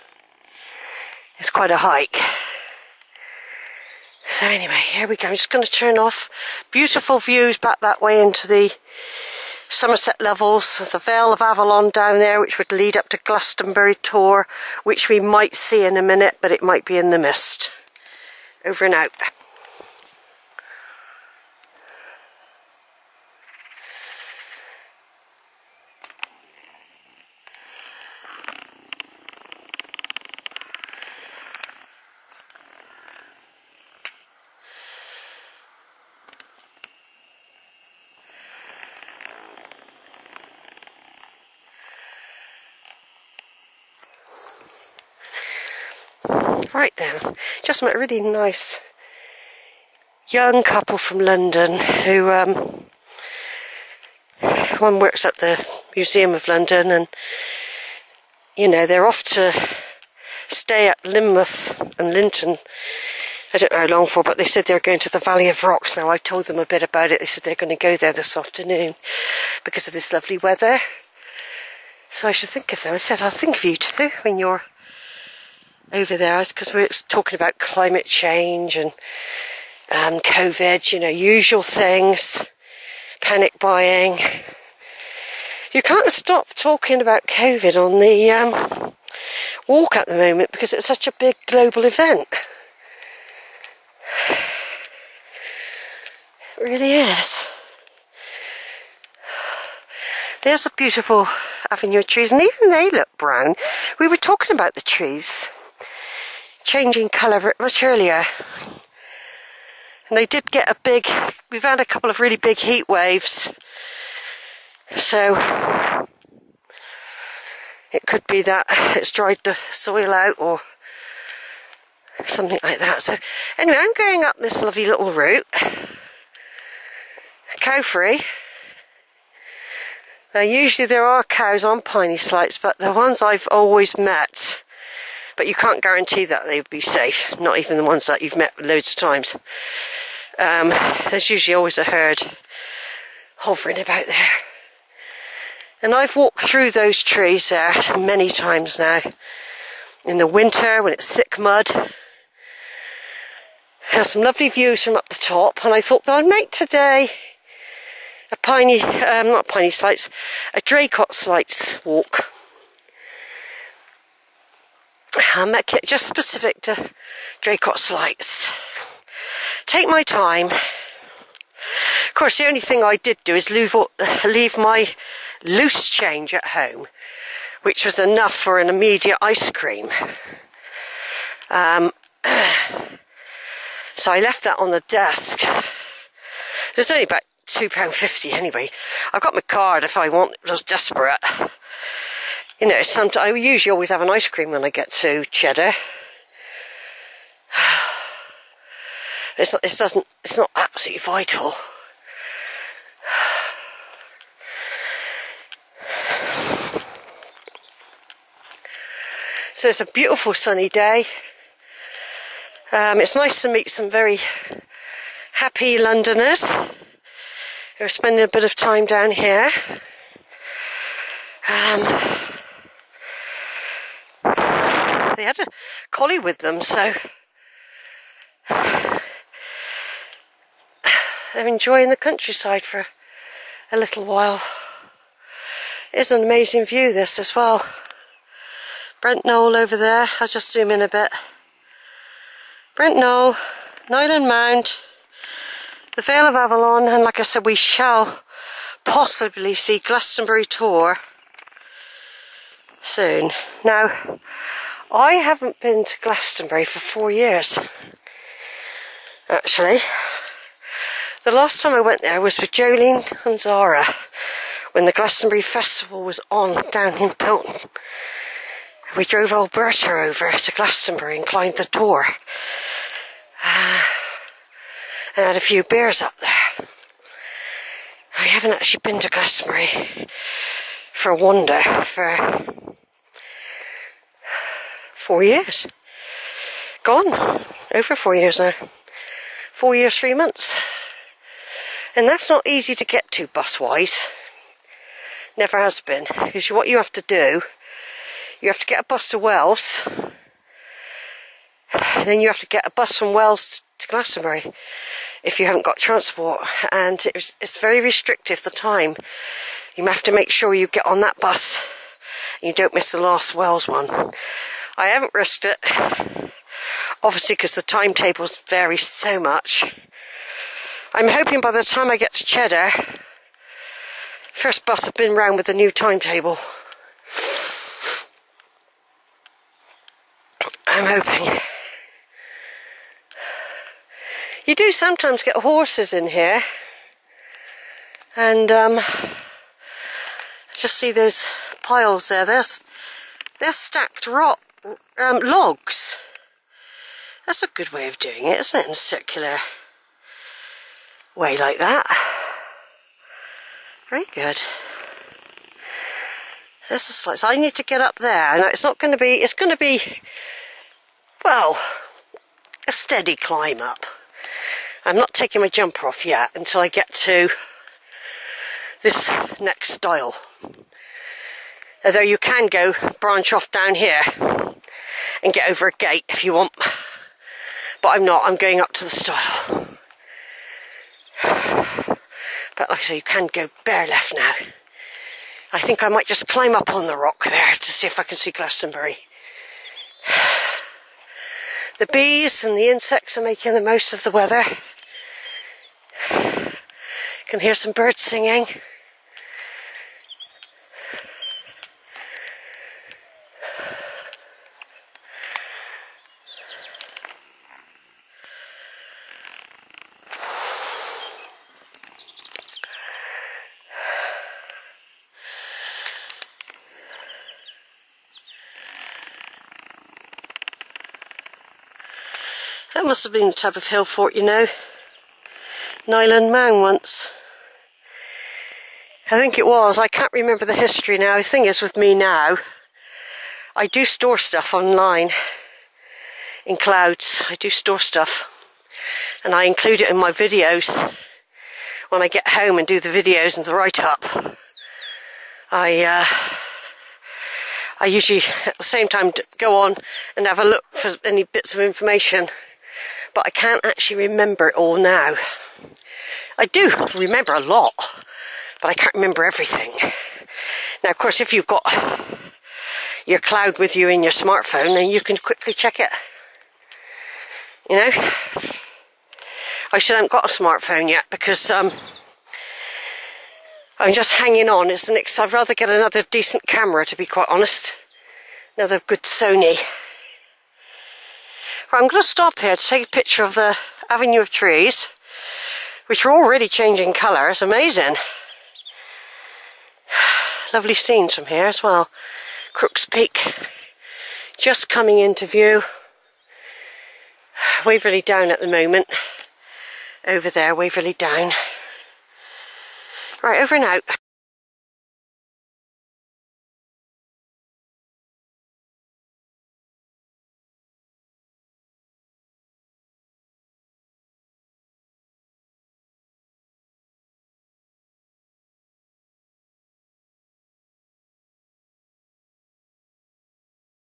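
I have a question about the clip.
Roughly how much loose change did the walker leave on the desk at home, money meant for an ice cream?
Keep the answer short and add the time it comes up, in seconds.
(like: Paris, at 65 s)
£2.50, at 187 s.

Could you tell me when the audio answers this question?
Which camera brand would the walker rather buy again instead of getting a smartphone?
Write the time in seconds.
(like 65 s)
479 s.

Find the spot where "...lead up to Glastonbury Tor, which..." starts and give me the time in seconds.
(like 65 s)
12 s.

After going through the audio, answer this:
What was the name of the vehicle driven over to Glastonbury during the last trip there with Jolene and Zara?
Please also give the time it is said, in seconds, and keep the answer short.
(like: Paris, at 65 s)
Alberta, at 269 s.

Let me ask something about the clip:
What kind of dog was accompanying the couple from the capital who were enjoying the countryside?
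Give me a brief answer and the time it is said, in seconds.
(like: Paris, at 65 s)
Collie, at 225 s.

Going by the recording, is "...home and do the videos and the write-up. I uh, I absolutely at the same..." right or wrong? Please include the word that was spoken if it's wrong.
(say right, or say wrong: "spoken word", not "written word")
wrong: "usually", not "absolutely".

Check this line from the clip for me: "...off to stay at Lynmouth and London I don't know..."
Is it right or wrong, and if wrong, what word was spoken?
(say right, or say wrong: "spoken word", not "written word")
wrong: "Lynton", not "London".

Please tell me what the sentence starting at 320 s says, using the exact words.
I'm hoping by the time I get to Cheddar, first bus have been round with the new timetable.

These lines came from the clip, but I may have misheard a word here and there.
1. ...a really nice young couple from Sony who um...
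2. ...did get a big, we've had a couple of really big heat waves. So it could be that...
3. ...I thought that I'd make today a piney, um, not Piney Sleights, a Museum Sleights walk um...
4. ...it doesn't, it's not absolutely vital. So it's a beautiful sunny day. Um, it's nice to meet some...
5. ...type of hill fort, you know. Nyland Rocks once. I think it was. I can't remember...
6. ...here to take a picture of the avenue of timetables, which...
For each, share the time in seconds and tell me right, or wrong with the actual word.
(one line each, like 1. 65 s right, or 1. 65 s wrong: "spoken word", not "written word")
1. 47 s wrong: "London", not "Sony"
2. 110 s right
3. 155 s wrong: "Draycott", not "Museum"
4. 199 s right
5. 423 s wrong: "Man", not "Rocks"
6. 482 s wrong: "trees", not "timetables".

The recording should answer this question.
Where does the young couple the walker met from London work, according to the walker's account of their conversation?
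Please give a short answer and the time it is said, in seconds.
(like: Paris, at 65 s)
Museum of London, at 55 s.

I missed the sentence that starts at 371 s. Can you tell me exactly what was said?
Although you can go branch off down here and get over a gate if you want.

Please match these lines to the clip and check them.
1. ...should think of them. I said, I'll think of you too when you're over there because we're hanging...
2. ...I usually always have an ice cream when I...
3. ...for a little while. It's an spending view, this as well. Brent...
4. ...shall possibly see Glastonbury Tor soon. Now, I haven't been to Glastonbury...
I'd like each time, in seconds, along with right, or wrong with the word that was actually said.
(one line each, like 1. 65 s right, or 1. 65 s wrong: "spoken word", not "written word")
1. 72 s wrong: "talking", not "hanging"
2. 193 s right
3. 232 s wrong: "amazing", not "spending"
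4. 247 s right.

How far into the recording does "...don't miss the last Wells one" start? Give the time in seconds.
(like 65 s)
312 s.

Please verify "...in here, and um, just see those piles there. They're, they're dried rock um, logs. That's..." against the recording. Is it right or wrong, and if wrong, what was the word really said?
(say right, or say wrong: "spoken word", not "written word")
wrong: "stacked", not "dried".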